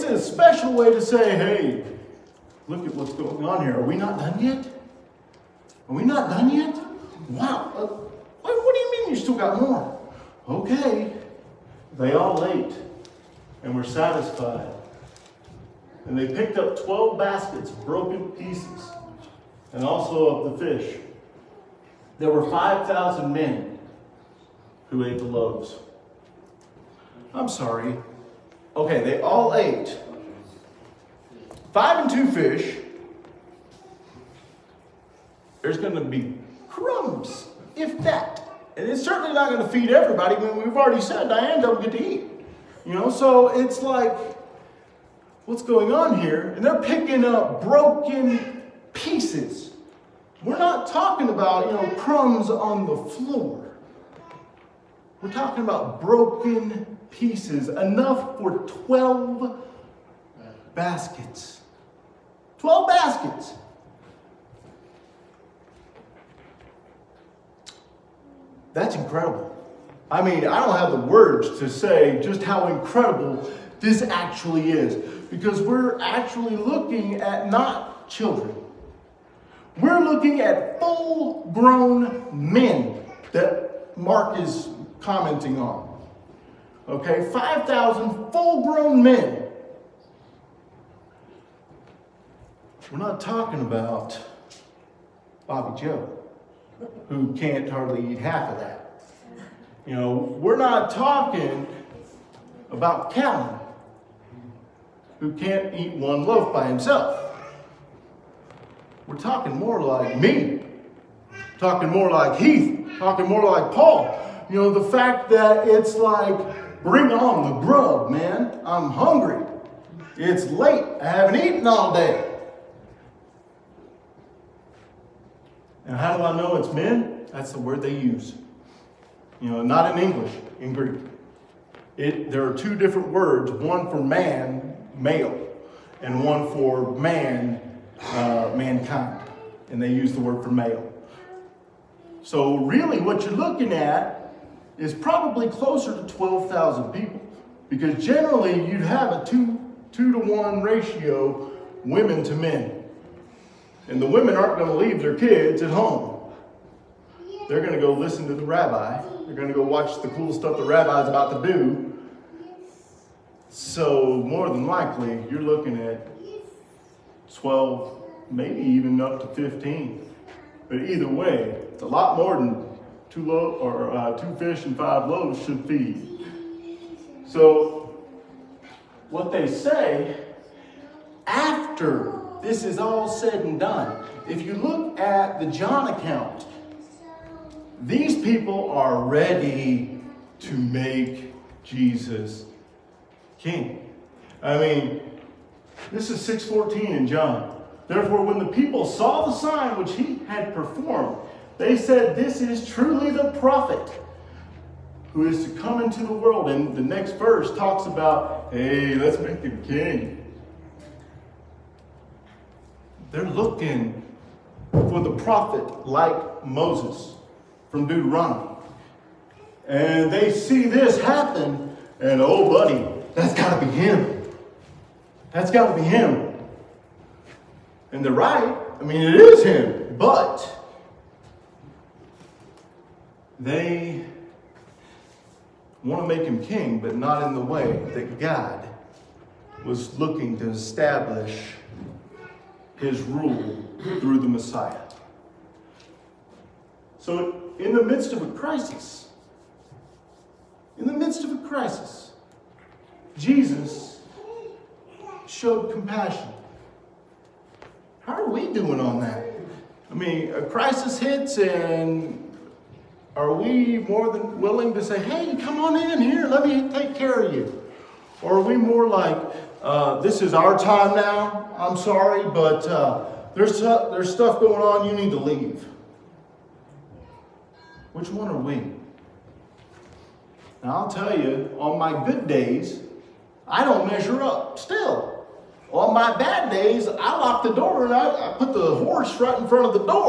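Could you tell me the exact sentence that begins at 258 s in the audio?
How are we doing on that?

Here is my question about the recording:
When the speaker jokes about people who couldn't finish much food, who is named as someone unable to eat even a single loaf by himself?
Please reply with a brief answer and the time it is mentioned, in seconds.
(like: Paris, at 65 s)
Callan, at 103 s.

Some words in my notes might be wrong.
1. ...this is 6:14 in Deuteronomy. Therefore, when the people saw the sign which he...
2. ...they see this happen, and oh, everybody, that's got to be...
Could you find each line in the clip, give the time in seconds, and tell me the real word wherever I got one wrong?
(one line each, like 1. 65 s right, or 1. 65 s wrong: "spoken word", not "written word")
1. 195 s wrong: "John", not "Deuteronomy"
2. 220 s wrong: "buddy", not "everybody".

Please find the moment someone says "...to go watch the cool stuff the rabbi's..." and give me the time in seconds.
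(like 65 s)
159 s.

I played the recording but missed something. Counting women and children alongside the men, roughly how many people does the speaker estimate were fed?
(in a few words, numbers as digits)
12,000.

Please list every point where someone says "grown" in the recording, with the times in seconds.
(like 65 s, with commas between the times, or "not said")
81 s, 88 s.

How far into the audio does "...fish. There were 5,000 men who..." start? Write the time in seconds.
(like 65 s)
20 s.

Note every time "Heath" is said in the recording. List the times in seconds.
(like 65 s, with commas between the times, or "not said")
112 s.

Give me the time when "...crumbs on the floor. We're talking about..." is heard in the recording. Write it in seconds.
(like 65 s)
51 s.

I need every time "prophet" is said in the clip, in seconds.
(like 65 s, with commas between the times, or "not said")
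203 s, 215 s.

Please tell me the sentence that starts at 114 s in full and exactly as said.
You know, the fact that it's like, bring on the grub, man.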